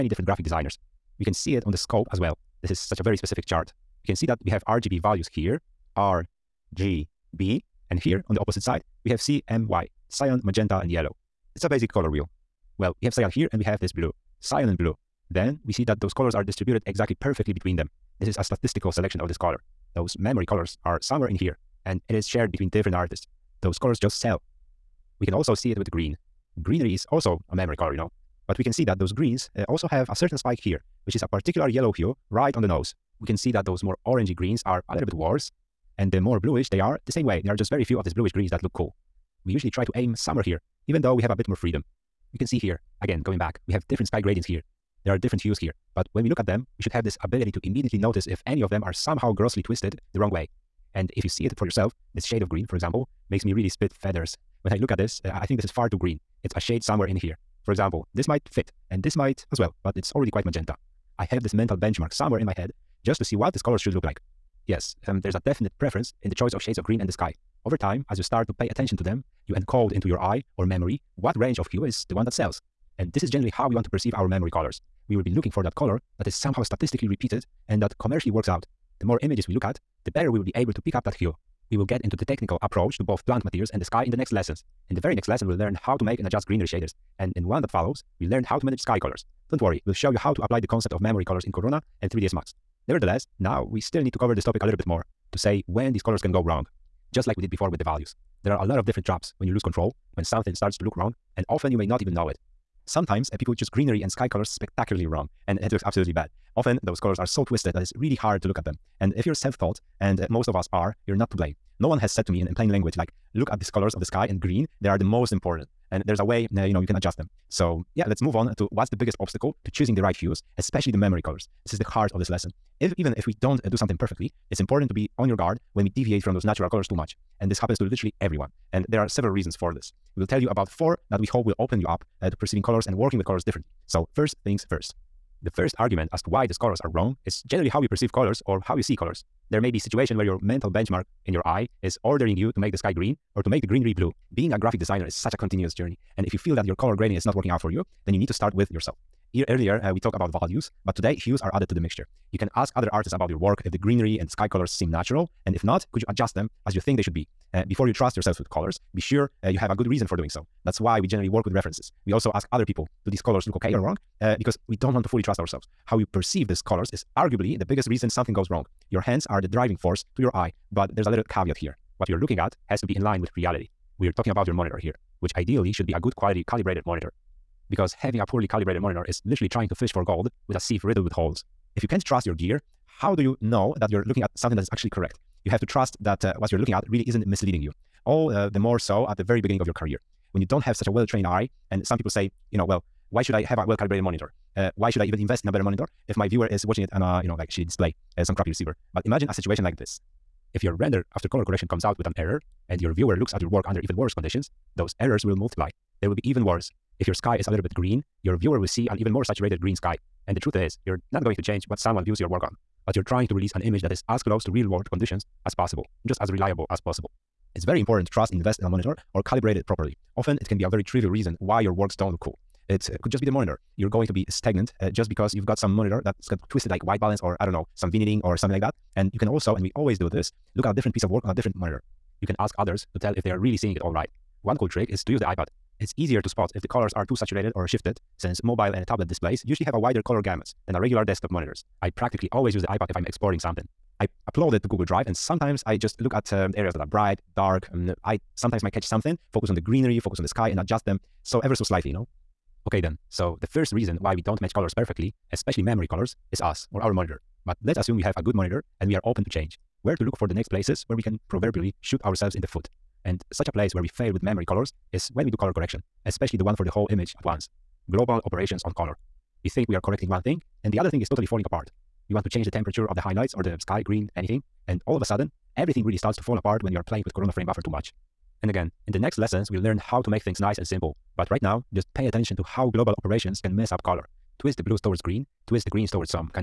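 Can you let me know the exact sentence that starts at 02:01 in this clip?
This is the heart of this lesson.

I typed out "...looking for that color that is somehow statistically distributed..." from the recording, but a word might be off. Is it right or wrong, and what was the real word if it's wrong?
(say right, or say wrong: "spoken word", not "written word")
wrong: "repeated", not "distributed".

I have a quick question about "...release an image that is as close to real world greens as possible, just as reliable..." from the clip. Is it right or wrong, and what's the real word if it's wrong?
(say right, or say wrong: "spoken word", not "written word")
wrong: "conditions", not "greens".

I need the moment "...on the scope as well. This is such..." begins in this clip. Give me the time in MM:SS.
00:01.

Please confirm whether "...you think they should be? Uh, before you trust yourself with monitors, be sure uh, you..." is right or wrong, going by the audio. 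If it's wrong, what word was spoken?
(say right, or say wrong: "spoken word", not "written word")
wrong: "colors", not "monitors".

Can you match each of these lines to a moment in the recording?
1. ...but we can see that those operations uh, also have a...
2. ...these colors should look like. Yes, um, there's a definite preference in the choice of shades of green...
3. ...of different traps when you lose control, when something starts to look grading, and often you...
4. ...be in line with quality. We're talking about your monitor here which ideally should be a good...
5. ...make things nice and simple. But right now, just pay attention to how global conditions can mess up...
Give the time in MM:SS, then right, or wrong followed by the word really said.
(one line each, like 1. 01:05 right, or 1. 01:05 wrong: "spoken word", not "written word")
1. 00:28 wrong: "greens", not "operations"
2. 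01:03 right
3. 01:38 wrong: "wrong", not "grading"
4. 02:52 wrong: "reality", not "quality"
5. 04:40 wrong: "operations", not "conditions".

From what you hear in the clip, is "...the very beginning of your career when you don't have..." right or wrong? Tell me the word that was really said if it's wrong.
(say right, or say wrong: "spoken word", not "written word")
right.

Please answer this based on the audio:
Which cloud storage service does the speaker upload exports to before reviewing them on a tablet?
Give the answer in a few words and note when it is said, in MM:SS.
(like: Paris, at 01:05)
Google Drive, at 04:04.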